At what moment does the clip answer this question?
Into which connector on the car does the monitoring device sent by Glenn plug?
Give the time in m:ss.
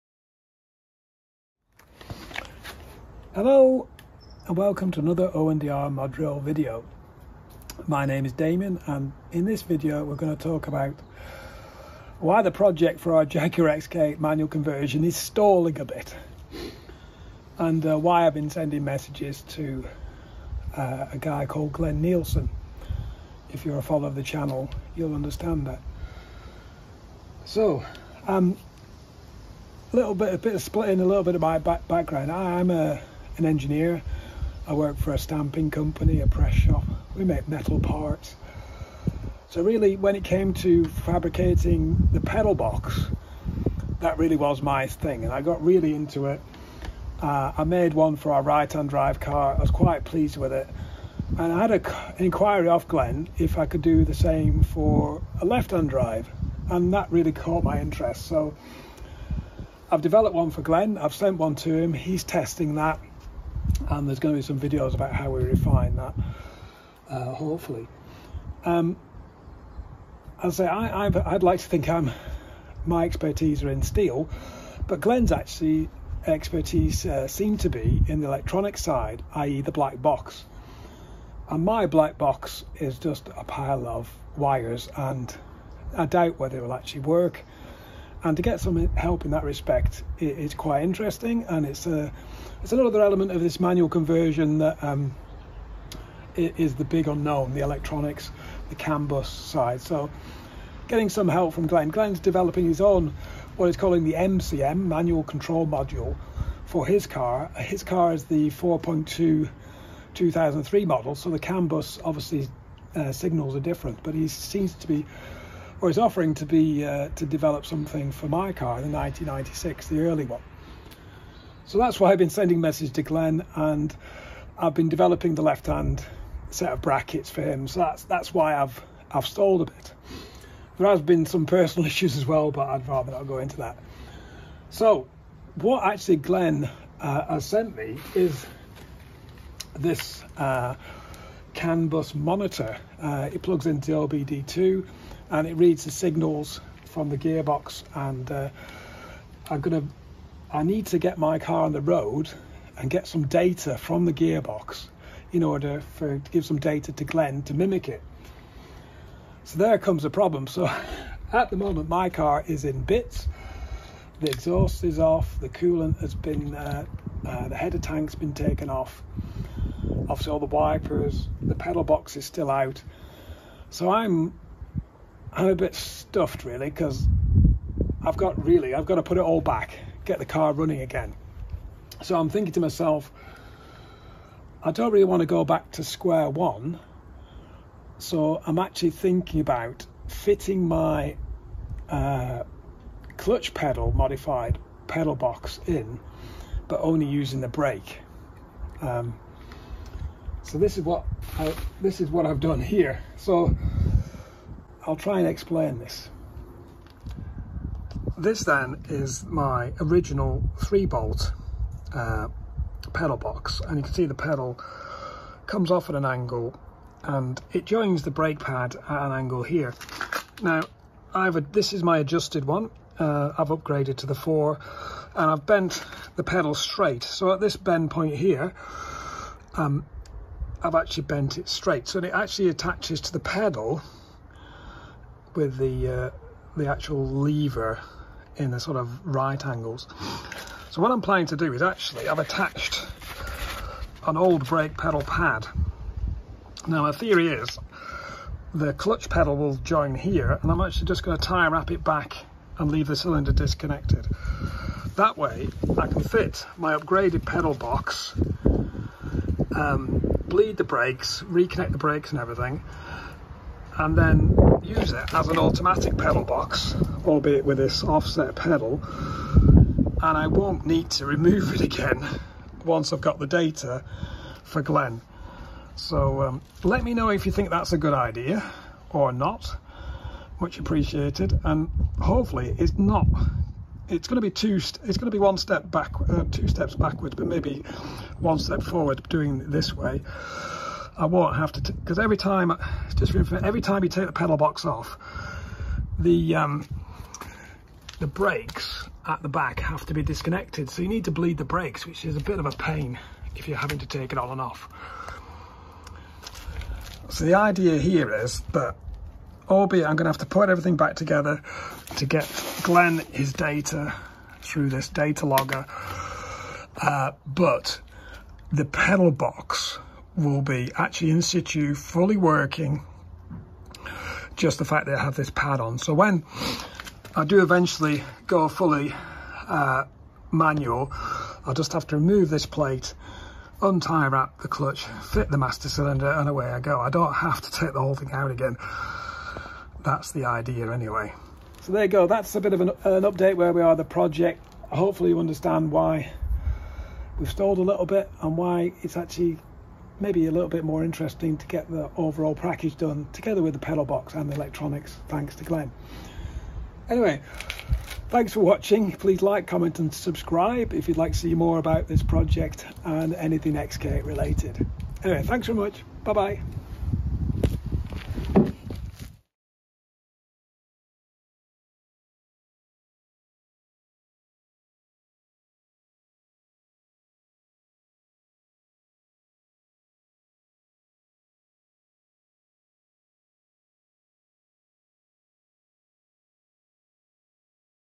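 2:23.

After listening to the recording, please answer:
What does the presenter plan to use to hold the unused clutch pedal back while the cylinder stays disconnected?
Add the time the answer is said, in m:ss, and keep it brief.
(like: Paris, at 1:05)
tie wrap, at 4:11.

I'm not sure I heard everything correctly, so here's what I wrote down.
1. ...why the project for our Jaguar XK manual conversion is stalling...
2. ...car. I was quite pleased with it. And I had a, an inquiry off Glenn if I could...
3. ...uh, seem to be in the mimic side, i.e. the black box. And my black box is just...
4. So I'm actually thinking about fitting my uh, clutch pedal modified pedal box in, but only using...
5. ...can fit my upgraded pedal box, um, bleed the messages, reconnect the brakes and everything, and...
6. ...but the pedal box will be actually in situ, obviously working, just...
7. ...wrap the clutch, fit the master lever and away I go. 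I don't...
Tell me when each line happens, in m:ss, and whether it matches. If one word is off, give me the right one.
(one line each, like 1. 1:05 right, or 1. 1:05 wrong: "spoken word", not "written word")
1. 0:12 right
2. 0:49 right
3. 1:17 wrong: "electronic", not "mimic"
4. 3:07 right
5. 4:15 wrong: "brakes", not "messages"
6. 5:17 wrong: "fully", not "obviously"
7. 5:34 wrong: "cylinder", not "lever".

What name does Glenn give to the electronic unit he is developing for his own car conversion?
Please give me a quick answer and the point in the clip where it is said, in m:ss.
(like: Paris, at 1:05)
manual control module, at 1:44.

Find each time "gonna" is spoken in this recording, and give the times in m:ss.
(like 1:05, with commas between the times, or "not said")
2:29, 5:09.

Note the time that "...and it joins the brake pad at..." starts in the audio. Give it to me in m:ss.
3:37.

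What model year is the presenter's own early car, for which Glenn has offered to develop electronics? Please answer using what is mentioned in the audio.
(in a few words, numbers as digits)
1996.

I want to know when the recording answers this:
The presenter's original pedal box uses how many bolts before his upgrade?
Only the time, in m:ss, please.
3:30.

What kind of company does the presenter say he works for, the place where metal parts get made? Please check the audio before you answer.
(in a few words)
stamping company.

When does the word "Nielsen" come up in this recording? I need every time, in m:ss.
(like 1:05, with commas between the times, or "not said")
0:22.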